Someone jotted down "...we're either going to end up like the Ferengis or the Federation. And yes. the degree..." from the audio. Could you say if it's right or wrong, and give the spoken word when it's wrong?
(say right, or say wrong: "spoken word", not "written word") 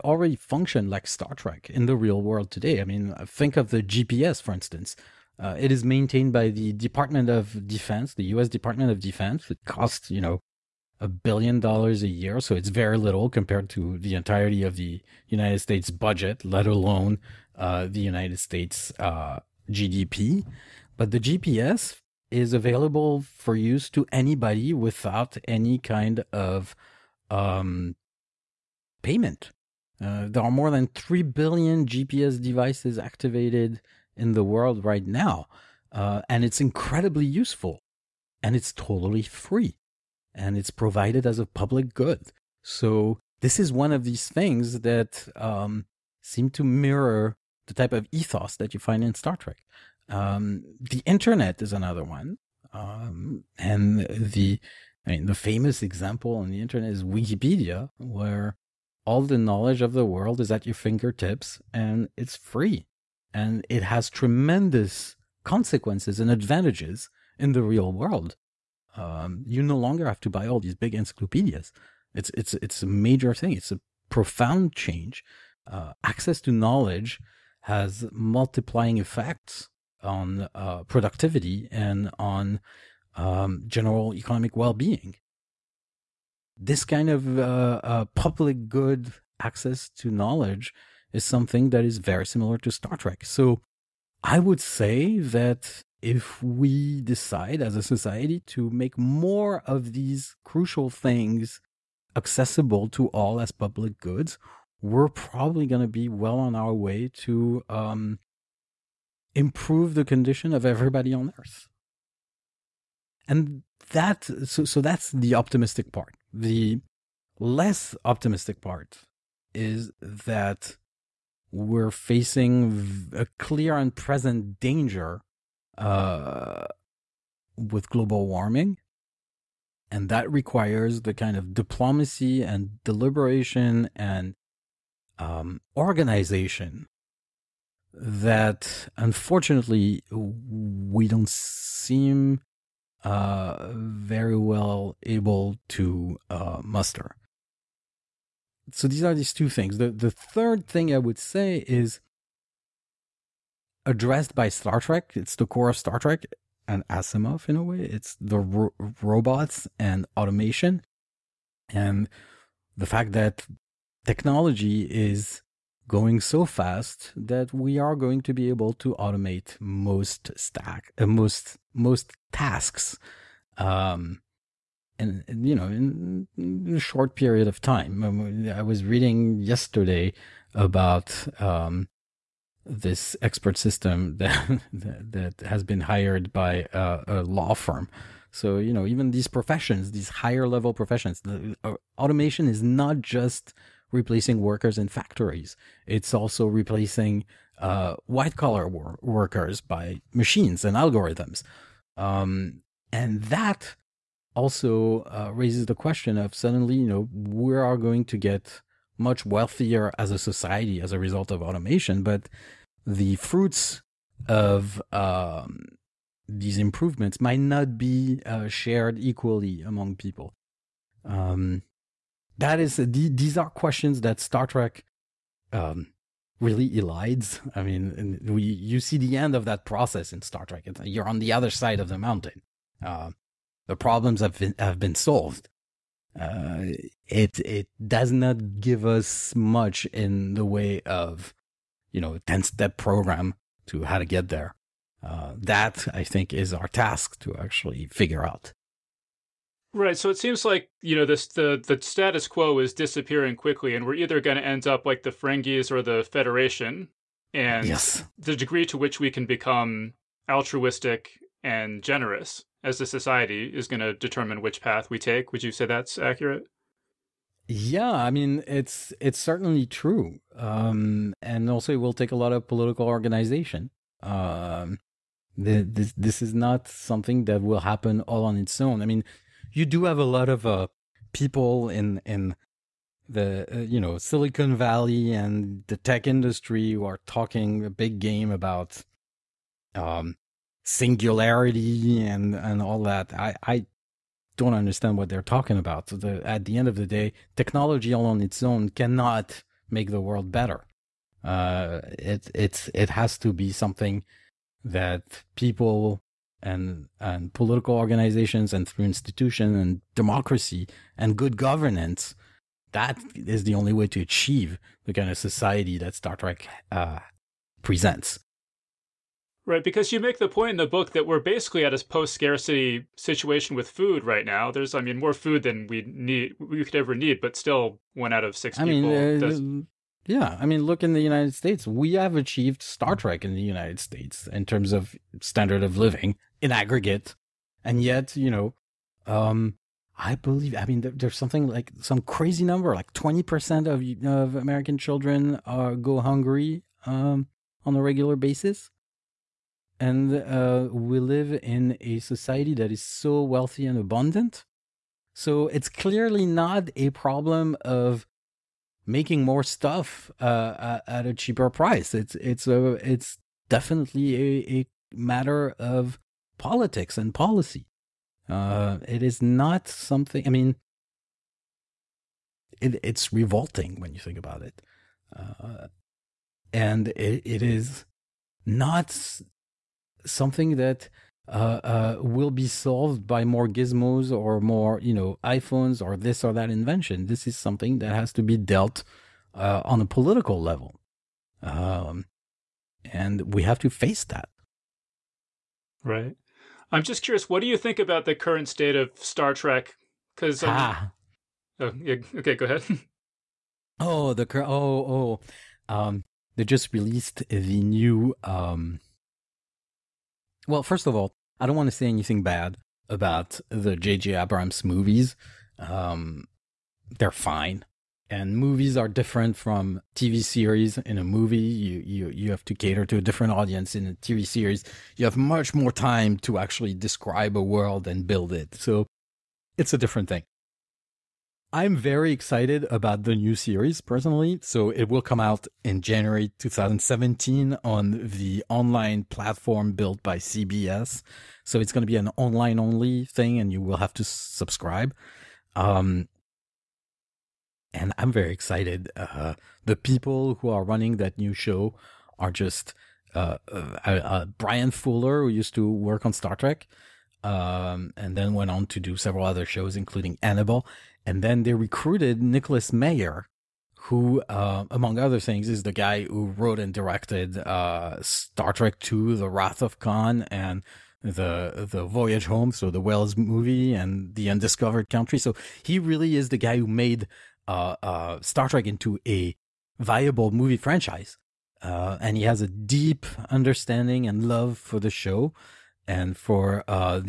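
right.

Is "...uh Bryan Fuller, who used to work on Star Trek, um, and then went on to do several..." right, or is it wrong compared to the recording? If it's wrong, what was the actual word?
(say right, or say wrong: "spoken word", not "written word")
right.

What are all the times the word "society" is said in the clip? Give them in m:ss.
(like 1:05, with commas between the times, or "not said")
1:37, 3:30, 4:22, 5:15, 5:51.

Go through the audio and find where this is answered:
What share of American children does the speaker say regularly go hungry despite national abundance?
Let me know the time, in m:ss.
5:42.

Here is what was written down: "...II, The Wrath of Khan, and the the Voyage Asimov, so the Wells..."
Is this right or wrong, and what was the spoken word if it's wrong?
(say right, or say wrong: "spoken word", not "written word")
wrong: "Home", not "Asimov".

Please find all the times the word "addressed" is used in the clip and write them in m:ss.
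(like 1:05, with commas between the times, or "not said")
2:33.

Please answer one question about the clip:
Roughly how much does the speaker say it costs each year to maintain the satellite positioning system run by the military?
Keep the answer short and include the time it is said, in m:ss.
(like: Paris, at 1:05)
1 billion dollars, at 0:10.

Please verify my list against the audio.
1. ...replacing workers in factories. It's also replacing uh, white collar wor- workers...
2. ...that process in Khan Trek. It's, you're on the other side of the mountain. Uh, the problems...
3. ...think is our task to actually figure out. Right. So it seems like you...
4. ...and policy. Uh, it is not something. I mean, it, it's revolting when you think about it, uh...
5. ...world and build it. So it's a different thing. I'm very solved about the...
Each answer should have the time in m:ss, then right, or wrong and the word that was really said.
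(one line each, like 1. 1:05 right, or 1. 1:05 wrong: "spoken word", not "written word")
1. 3:13 right
2. 3:49 wrong: "Star", not "Khan"
3. 4:06 right
4. 6:06 right
5. 7:07 wrong: "excited", not "solved".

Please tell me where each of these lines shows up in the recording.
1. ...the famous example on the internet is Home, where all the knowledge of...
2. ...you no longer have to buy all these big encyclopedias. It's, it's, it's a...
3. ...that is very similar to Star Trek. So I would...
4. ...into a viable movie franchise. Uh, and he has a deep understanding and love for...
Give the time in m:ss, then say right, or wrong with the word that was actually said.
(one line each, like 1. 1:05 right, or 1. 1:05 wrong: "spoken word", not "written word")
1. 0:55 wrong: "Wikipedia", not "Home"
2. 1:09 right
3. 1:31 right
4. 7:58 right.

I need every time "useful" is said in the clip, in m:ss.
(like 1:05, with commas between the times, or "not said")
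0:37.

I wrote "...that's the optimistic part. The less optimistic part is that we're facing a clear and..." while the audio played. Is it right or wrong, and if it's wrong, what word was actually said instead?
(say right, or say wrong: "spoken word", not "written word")
right.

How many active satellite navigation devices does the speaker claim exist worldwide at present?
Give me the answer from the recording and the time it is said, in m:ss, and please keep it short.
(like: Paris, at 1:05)
More than 3 billion, at 0:30.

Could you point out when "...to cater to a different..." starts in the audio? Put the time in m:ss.
7:02.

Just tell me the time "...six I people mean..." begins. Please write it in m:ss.
5:28.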